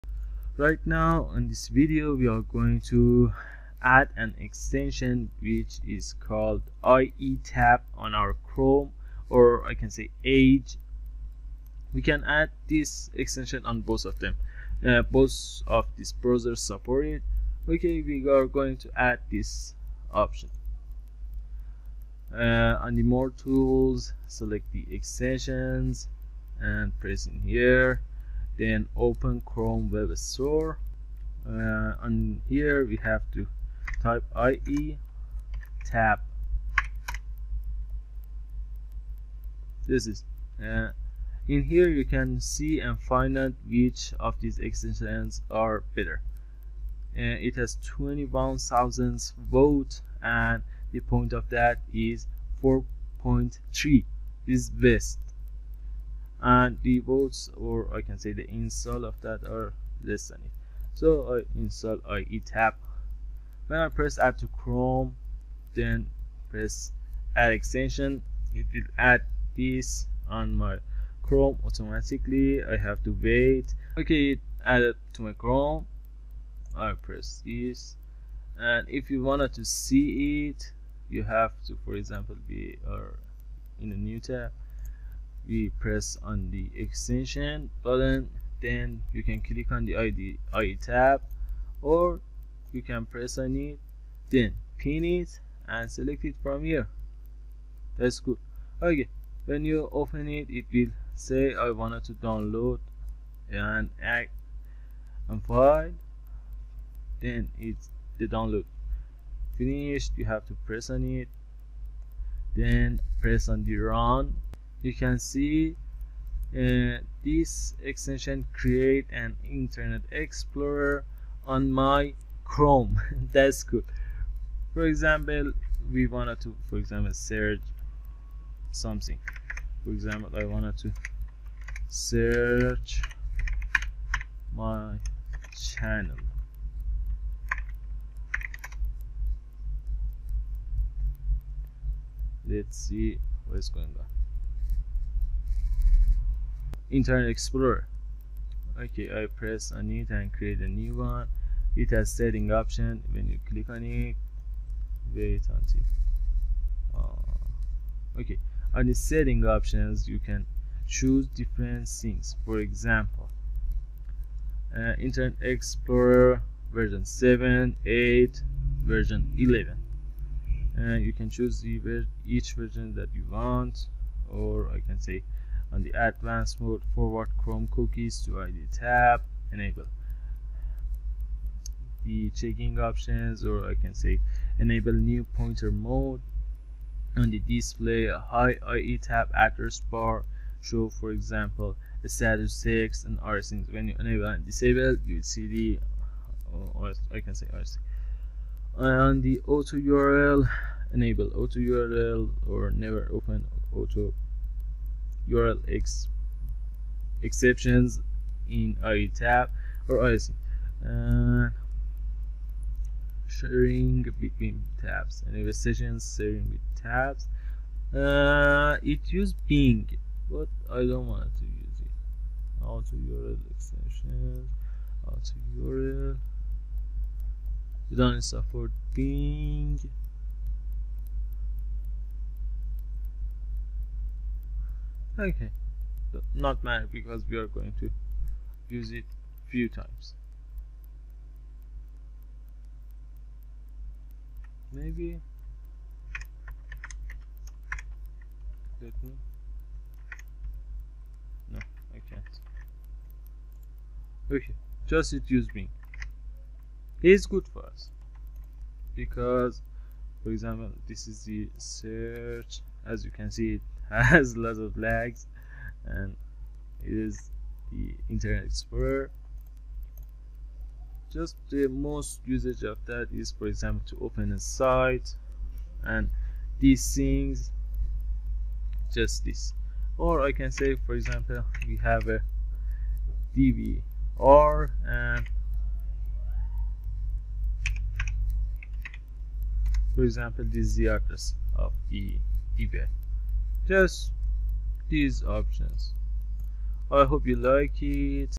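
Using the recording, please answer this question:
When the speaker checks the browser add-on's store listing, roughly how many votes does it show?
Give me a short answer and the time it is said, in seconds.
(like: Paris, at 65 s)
21,000, at 47 s.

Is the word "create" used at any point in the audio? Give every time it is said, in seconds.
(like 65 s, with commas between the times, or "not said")
118 s, 150 s.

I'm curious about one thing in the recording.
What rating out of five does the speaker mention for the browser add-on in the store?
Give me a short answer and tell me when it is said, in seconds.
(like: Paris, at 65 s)
4.3, at 52 s.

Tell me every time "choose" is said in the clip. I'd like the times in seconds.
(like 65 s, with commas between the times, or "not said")
160 s, 171 s.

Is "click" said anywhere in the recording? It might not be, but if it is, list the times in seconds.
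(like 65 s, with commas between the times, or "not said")
89 s, 153 s.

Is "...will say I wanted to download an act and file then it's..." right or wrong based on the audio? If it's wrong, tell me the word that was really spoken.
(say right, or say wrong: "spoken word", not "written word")
right.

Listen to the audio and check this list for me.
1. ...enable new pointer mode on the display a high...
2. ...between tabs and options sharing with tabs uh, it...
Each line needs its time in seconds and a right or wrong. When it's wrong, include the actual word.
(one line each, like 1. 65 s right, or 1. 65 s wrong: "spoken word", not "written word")
1. 184 s right
2. 214 s wrong: "sessions", not "options".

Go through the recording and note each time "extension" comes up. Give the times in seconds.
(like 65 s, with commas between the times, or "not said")
4 s, 13 s, 24 s, 44 s, 67 s, 86 s, 117 s, 223 s.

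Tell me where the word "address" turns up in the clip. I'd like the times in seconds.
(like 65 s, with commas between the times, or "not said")
189 s, 290 s.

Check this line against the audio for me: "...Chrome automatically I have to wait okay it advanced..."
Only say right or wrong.
wrong.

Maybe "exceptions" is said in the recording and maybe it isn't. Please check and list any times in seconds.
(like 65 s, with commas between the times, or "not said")
207 s.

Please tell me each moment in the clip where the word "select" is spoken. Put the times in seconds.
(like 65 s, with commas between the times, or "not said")
24 s, 95 s.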